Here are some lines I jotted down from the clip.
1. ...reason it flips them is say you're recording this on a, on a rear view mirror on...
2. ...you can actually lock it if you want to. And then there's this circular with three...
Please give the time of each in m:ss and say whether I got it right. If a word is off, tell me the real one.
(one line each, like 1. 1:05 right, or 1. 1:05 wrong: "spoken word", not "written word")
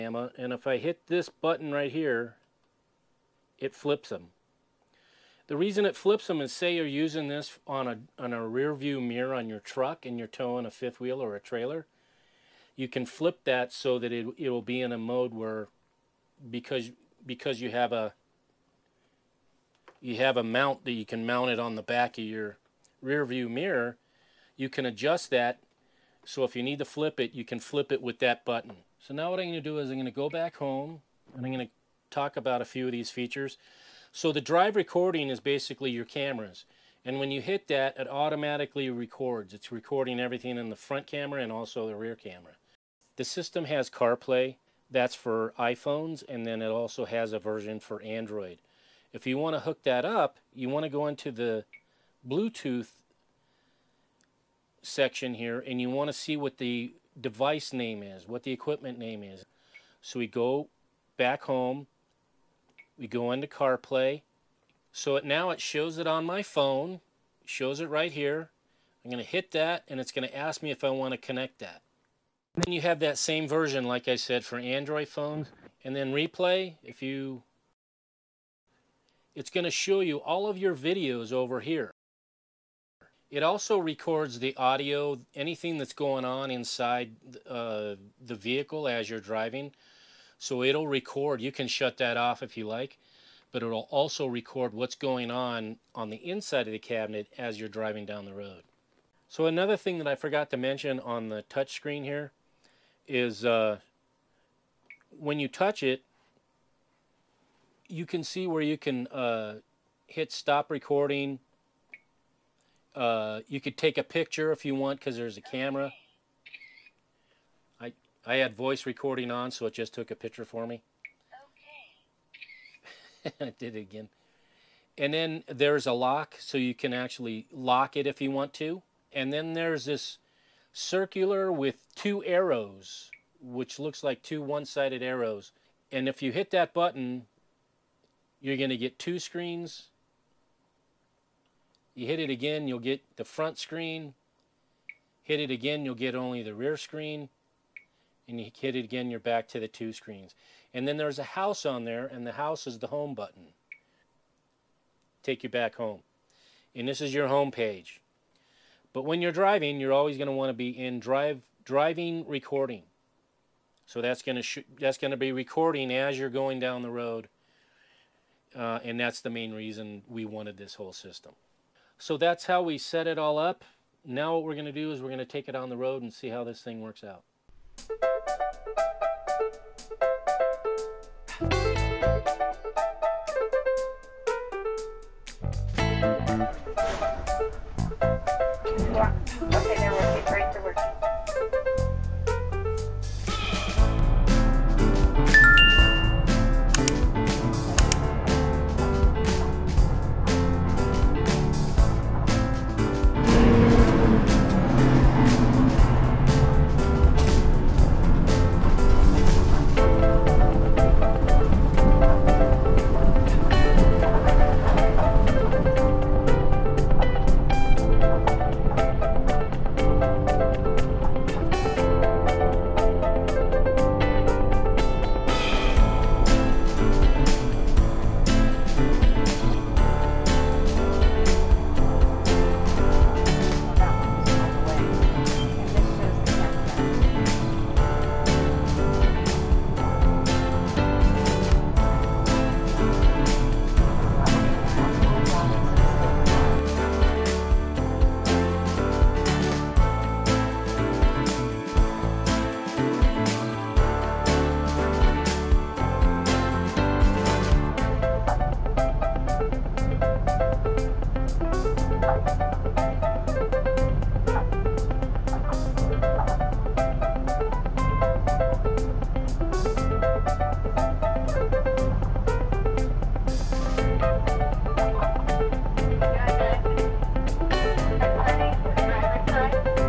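1. 0:05 wrong: "using", not "recording"
2. 2:06 wrong: "two", not "three".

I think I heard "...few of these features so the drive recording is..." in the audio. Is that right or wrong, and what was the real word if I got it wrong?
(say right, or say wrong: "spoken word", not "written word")
right.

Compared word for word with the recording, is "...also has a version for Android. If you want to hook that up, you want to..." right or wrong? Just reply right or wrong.
right.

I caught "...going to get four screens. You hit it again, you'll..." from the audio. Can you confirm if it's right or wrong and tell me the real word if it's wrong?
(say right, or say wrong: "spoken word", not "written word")
wrong: "two", not "four".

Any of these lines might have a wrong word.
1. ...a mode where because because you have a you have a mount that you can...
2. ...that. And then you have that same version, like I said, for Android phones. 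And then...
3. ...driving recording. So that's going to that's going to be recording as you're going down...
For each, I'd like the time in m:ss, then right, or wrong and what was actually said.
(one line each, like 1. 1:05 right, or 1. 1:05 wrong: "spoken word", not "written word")
1. 0:14 right
2. 1:11 right
3. 2:41 right.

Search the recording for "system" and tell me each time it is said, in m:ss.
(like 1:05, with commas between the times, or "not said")
0:43, 2:50.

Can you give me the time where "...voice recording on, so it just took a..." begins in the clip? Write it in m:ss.
1:58.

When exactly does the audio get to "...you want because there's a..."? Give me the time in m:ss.
1:54.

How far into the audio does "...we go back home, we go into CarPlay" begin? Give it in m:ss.
1:00.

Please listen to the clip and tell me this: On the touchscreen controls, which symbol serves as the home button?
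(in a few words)
a house.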